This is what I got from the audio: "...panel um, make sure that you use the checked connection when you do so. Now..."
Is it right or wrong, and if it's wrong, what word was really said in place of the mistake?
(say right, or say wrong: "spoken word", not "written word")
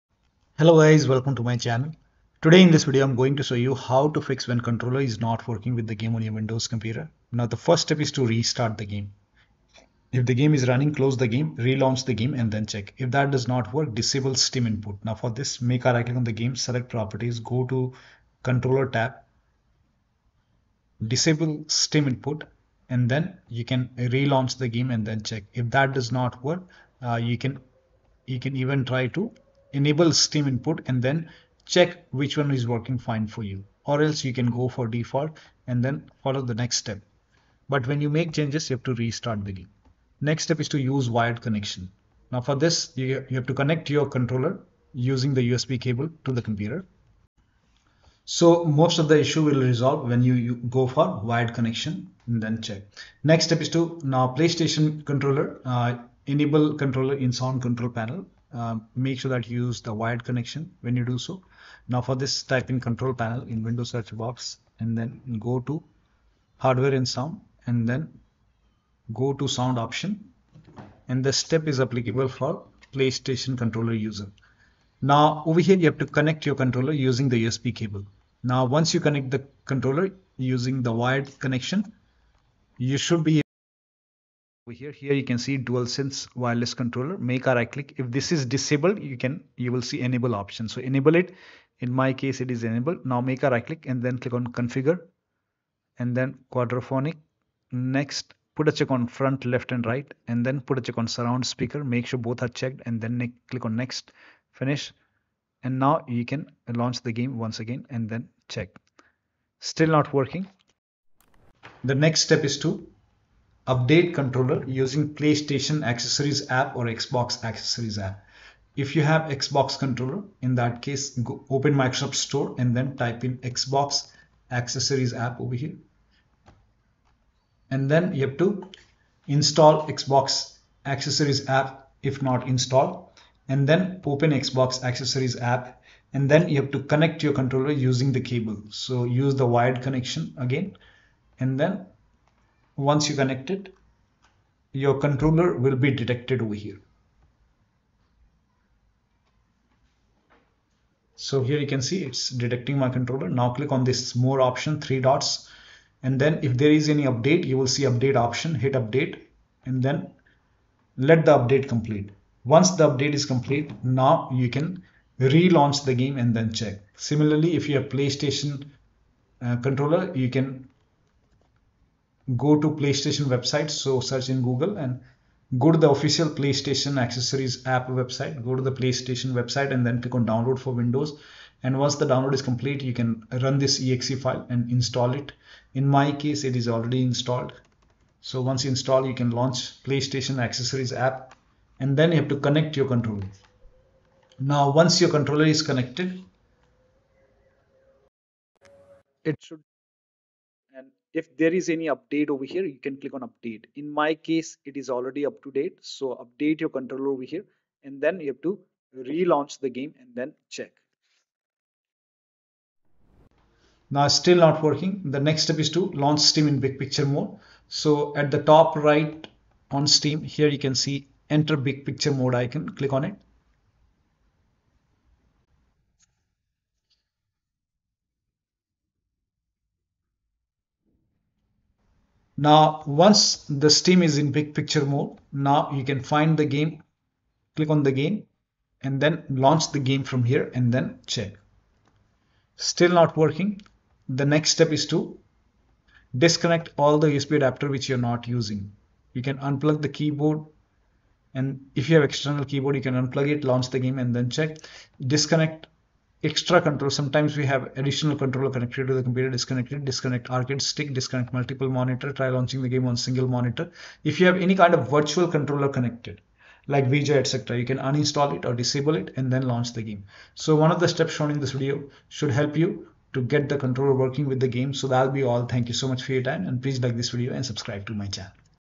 wrong: "wired", not "checked".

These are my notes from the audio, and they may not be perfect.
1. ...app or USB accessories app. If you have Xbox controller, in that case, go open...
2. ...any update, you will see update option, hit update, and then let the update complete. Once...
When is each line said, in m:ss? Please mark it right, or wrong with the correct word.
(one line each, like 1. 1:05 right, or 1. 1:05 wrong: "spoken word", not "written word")
1. 1:56 wrong: "Xbox", not "USB"
2. 2:36 right.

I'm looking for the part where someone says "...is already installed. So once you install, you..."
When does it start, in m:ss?
3:06.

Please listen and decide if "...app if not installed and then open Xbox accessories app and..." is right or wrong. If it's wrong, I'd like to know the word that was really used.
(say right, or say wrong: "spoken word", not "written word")
right.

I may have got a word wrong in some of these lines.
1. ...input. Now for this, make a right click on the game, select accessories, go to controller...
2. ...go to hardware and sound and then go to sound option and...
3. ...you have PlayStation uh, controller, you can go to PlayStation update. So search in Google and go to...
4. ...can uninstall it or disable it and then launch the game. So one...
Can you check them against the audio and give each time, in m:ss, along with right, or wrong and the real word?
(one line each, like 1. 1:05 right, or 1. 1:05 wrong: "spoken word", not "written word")
1. 0:14 wrong: "properties", not "accessories"
2. 1:05 right
3. 2:47 wrong: "website", not "update"
4. 4:27 right.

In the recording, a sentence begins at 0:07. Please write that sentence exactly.
Now the first step is to restart the game.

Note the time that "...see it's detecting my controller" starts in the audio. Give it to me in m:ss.
2:31.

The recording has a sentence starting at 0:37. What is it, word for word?
But when you make changes, you have to restart the game.